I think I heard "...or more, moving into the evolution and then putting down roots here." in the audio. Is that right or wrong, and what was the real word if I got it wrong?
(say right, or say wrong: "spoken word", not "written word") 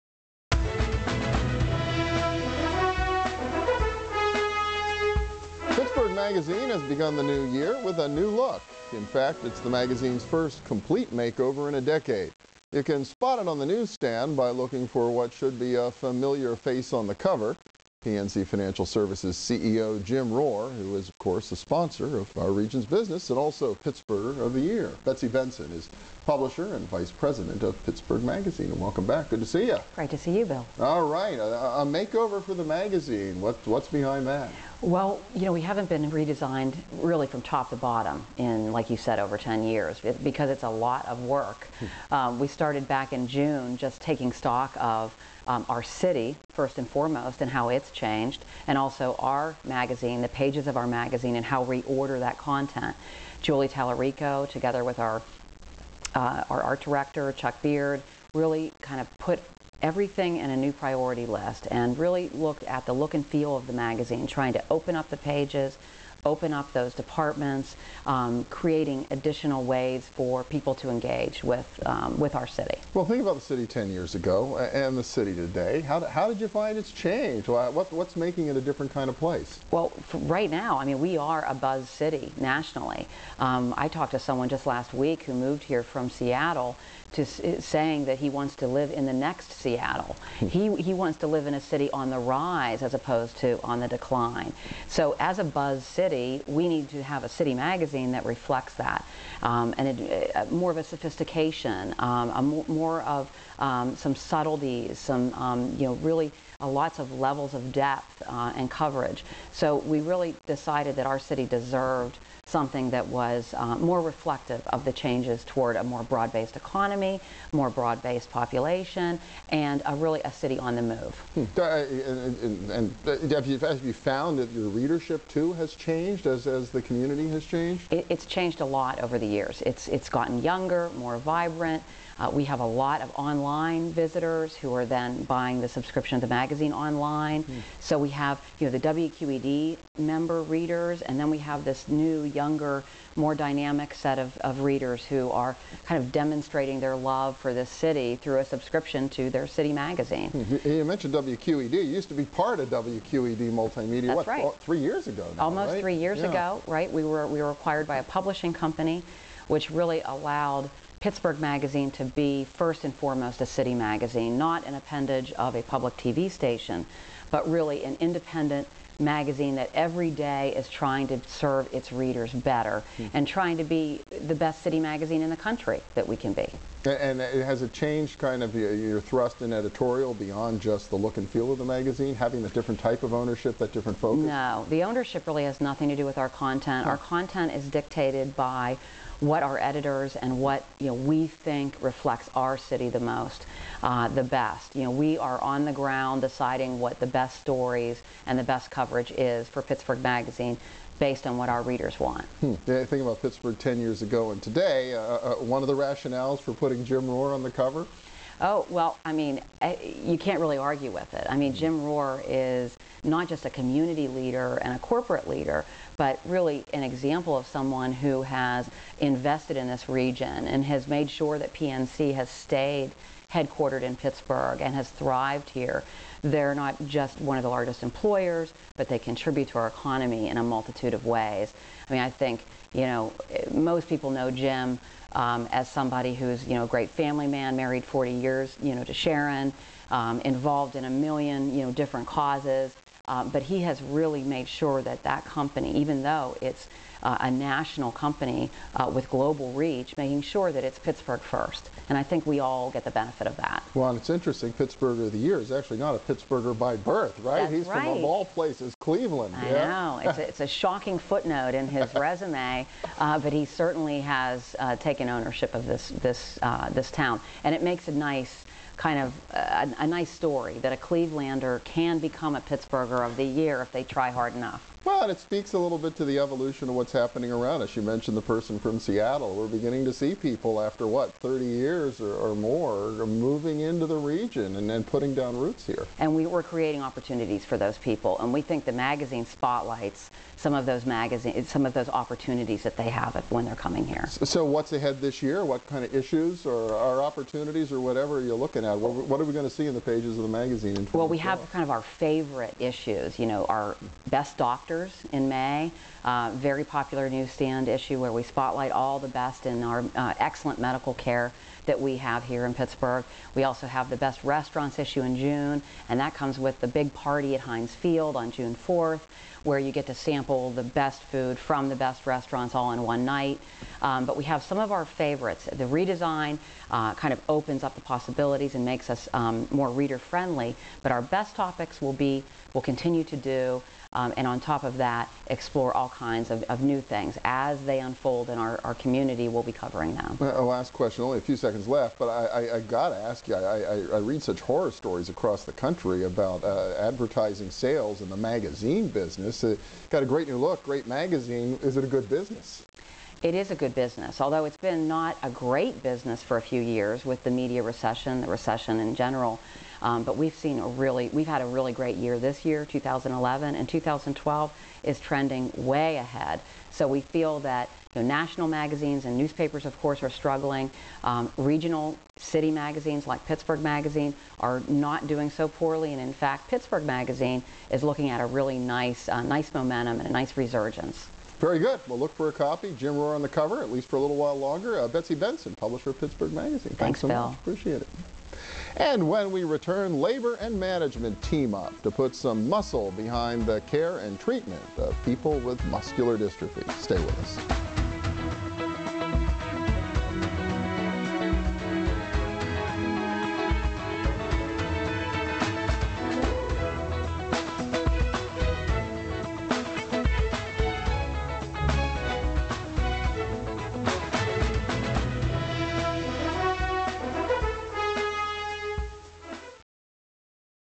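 wrong: "region", not "evolution".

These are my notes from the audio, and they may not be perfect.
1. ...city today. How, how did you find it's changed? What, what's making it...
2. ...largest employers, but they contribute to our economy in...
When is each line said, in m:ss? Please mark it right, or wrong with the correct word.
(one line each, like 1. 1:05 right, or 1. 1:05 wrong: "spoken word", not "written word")
1. 1:15 right
2. 3:47 right.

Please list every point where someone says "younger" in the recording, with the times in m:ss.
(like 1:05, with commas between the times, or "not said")
2:10, 2:22.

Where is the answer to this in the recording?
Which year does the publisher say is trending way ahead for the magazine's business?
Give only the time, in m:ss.
6:03.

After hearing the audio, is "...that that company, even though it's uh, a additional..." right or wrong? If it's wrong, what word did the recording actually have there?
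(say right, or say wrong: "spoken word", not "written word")
wrong: "national", not "additional".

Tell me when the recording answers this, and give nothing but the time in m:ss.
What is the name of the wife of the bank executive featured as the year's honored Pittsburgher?
3:58.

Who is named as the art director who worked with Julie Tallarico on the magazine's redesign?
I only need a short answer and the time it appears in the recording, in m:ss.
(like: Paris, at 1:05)
Chuck Beard, at 0:57.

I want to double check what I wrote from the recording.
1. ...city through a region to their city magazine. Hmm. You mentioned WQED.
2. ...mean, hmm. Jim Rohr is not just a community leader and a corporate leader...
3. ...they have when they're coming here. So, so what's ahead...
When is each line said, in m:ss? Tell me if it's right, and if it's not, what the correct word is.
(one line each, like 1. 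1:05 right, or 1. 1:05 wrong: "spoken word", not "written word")
1. 2:27 wrong: "subscription", not "region"
2. 3:31 right
3. 4:52 right.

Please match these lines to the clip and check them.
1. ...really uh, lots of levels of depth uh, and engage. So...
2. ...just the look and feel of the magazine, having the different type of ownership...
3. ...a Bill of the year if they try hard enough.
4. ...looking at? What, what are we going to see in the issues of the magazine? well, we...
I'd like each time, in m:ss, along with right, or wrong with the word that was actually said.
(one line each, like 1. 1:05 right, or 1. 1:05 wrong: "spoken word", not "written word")
1. 1:45 wrong: "coverage", not "engage"
2. 3:00 right
3. 4:32 wrong: "Pittsburgher", not "Bill"
4. 4:58 wrong: "pages", not "issues".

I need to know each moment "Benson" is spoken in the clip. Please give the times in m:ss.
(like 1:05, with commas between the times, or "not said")
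0:25, 6:25.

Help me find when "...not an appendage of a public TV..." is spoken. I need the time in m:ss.
2:44.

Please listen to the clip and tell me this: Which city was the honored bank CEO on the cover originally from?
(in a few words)
Cleveland.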